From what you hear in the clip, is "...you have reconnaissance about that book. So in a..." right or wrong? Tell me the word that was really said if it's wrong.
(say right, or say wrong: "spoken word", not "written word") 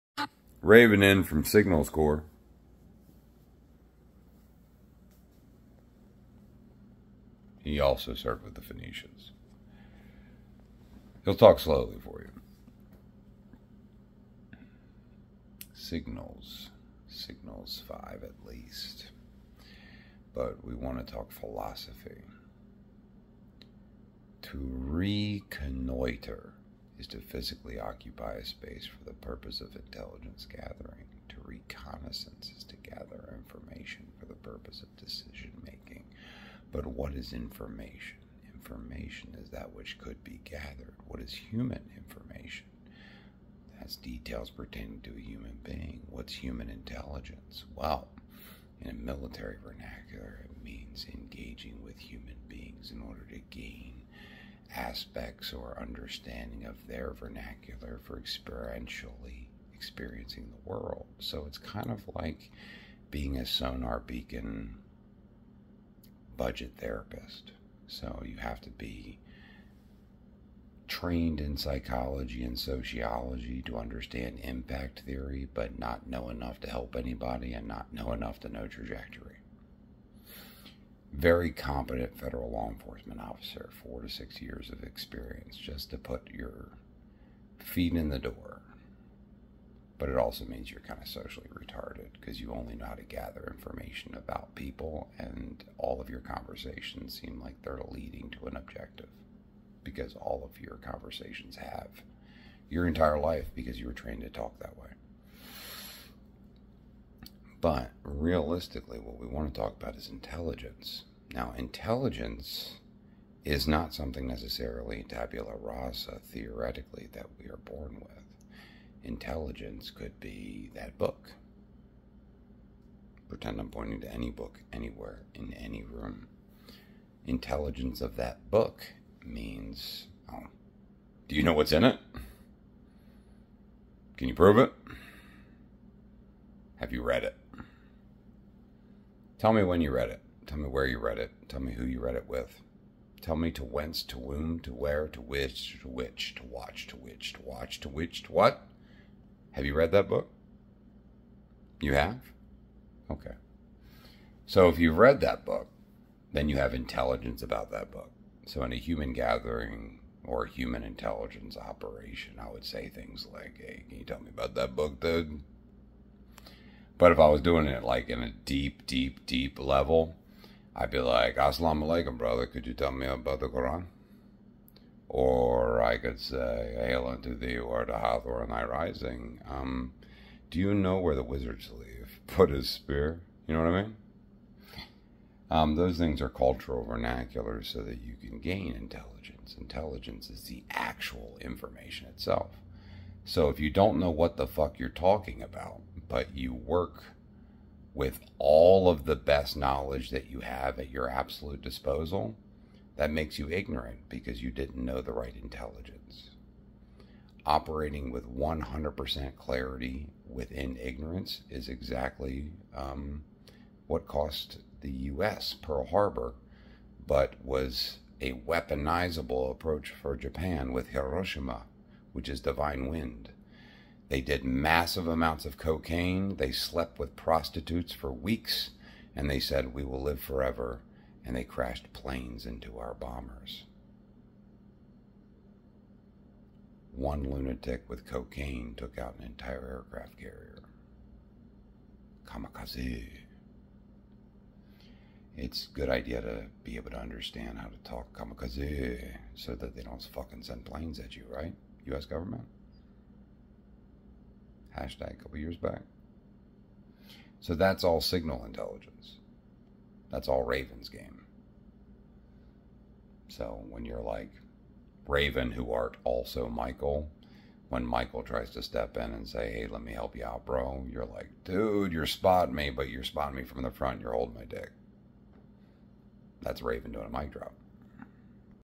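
wrong: "intelligence", not "reconnaissance".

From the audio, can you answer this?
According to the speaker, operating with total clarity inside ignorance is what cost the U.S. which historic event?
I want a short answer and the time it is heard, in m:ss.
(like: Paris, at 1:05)
Pearl Harbor, at 3:35.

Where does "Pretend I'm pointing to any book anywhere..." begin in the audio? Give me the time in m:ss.
2:03.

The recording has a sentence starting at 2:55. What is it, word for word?
Or I could say, Hail unto thee, art to Hathor and thy rising.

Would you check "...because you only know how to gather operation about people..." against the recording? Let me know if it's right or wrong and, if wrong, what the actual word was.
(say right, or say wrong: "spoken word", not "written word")
wrong: "information", not "operation".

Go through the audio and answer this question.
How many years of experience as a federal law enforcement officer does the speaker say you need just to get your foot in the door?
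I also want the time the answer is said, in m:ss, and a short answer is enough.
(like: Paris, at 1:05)
4 to 6, at 1:23.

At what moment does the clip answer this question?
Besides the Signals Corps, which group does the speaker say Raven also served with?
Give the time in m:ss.
0:08.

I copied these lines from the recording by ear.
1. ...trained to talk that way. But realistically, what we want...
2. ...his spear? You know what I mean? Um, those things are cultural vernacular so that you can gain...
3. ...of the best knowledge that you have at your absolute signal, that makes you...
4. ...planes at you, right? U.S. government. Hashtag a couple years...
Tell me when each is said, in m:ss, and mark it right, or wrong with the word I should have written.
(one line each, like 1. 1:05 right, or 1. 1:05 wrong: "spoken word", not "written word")
1. 1:43 right
2. 3:02 right
3. 3:18 wrong: "disposal", not "signal"
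4. 4:10 right.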